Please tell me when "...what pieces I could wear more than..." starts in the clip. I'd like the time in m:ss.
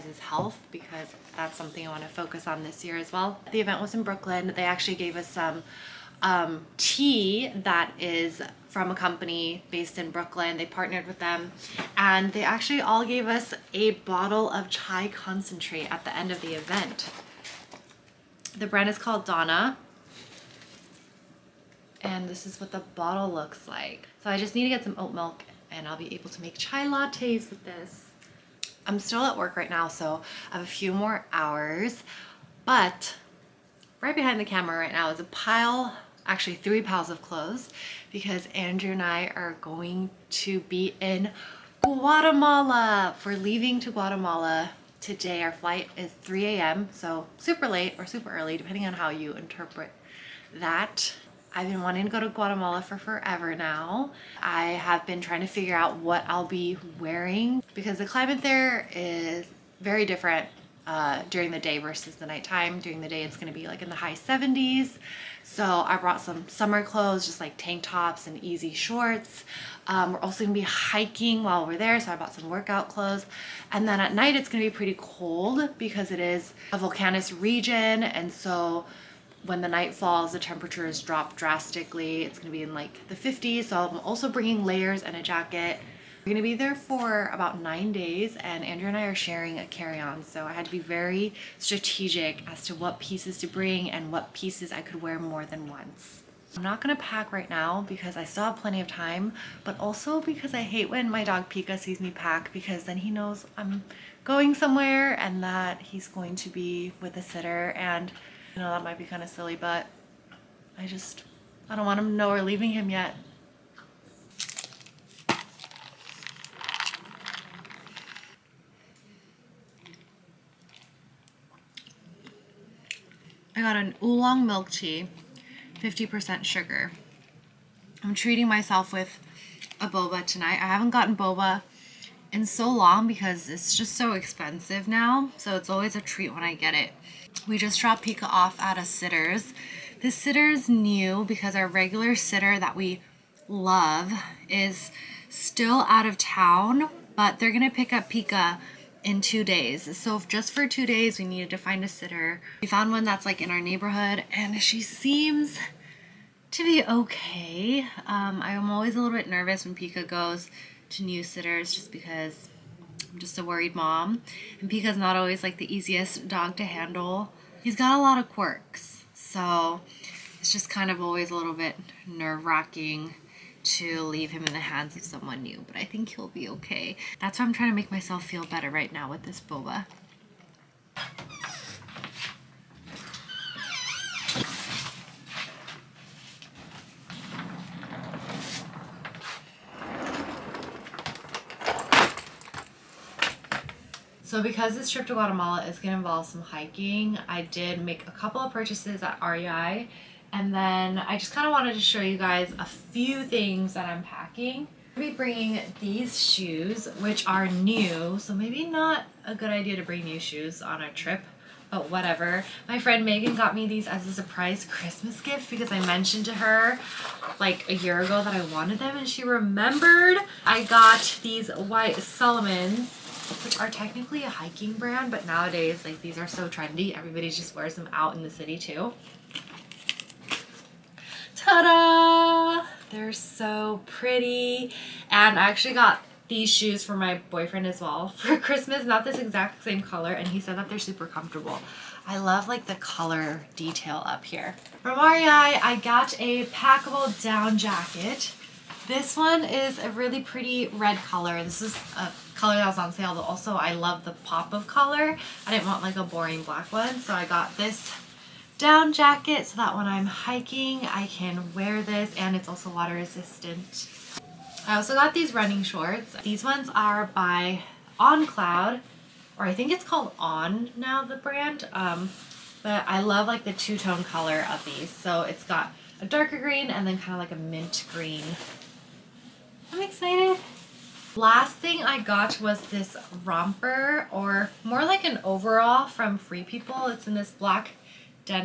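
1:34.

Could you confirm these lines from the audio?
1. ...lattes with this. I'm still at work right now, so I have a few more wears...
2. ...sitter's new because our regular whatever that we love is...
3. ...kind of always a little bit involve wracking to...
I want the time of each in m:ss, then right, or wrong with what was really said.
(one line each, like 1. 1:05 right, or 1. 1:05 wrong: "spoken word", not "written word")
1. 0:26 wrong: "hours", not "wears"
2. 2:20 wrong: "sitter", not "whatever"
3. 2:50 wrong: "nerve", not "involve".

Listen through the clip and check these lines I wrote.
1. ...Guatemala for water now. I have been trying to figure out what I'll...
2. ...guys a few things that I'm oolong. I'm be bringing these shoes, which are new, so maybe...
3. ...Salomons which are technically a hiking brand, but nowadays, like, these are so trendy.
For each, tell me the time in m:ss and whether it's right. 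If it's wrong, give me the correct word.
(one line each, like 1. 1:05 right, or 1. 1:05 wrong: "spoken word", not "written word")
1. 0:52 wrong: "forever", not "water"
2. 3:22 wrong: "packing", not "oolong"
3. 3:41 right.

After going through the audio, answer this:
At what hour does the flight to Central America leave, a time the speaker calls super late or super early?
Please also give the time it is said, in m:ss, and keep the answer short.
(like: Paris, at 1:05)
3 a.m., at 0:46.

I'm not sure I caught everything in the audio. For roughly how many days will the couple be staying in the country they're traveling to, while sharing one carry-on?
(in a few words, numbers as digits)
9.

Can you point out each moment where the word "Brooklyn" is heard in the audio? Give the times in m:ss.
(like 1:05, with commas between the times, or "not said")
0:04, 0:10.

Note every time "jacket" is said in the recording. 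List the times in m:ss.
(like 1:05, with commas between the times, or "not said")
1:25, 4:07, 4:18.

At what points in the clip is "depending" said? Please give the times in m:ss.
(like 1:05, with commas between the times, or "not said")
0:48.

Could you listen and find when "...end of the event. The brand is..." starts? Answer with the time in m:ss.
0:16.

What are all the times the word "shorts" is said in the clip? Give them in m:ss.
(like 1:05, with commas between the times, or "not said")
1:08, 4:25.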